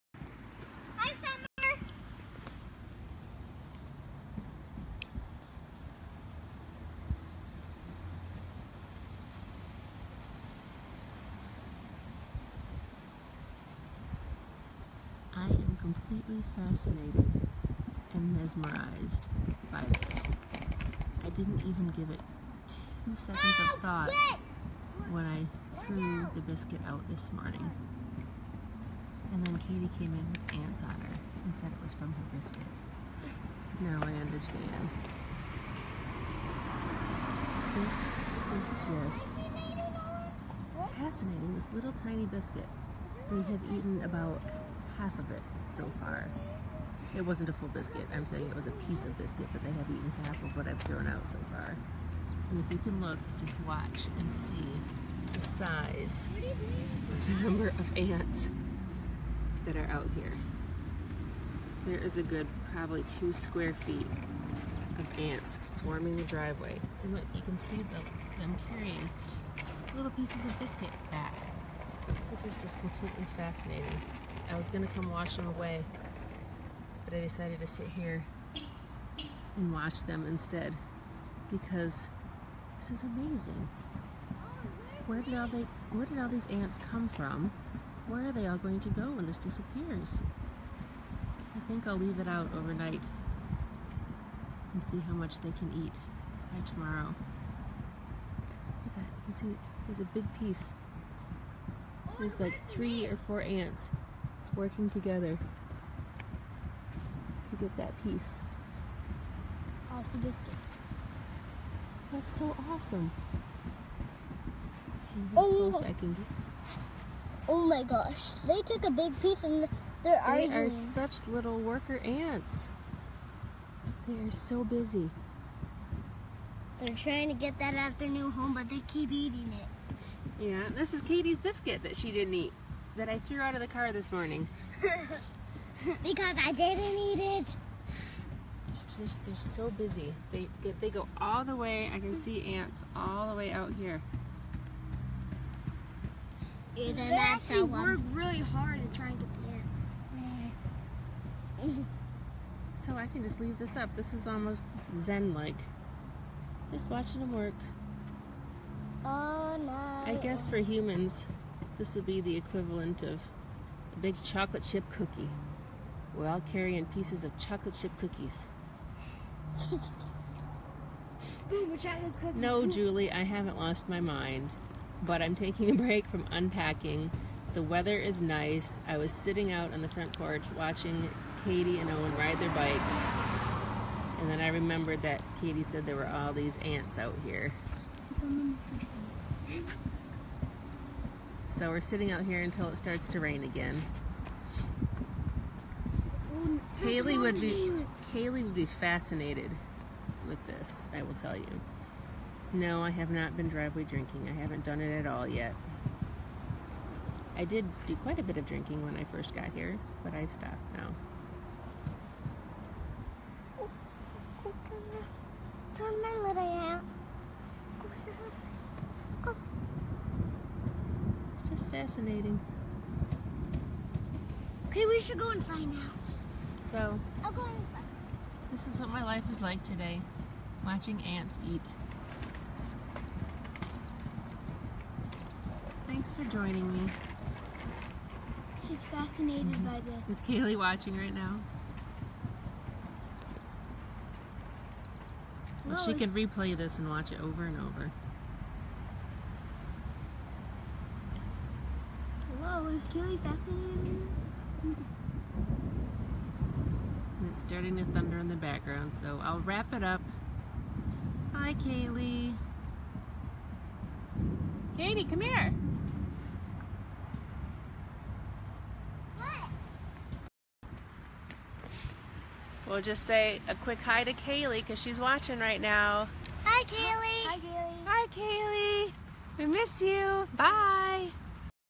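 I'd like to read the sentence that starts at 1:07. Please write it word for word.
And look, you can see them carrying little pieces of biscuit back.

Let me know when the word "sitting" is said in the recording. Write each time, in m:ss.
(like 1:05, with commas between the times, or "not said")
2:59, 3:11.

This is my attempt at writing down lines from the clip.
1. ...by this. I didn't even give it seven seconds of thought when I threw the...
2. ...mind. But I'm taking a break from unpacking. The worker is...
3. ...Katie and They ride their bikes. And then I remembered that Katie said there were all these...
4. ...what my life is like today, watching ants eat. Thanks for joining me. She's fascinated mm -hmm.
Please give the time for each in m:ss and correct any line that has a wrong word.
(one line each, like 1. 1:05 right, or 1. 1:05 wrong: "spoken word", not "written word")
1. 0:19 wrong: "two", not "seven"
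2. 2:53 wrong: "weather", not "worker"
3. 3:01 wrong: "Owen", not "They"
4. 3:48 right.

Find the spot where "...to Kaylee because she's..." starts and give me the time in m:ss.
4:34.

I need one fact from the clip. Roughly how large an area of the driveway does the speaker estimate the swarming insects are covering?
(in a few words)
2 square feet.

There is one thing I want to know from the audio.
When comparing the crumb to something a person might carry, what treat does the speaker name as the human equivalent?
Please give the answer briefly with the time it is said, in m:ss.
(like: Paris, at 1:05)
chocolate chip cookie, at 2:44.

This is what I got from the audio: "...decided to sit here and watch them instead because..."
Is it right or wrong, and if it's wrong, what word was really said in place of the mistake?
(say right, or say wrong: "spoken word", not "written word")
right.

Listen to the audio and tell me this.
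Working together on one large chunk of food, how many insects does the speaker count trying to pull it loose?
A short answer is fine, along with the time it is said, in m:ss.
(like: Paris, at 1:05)
3 or 4, at 1:42.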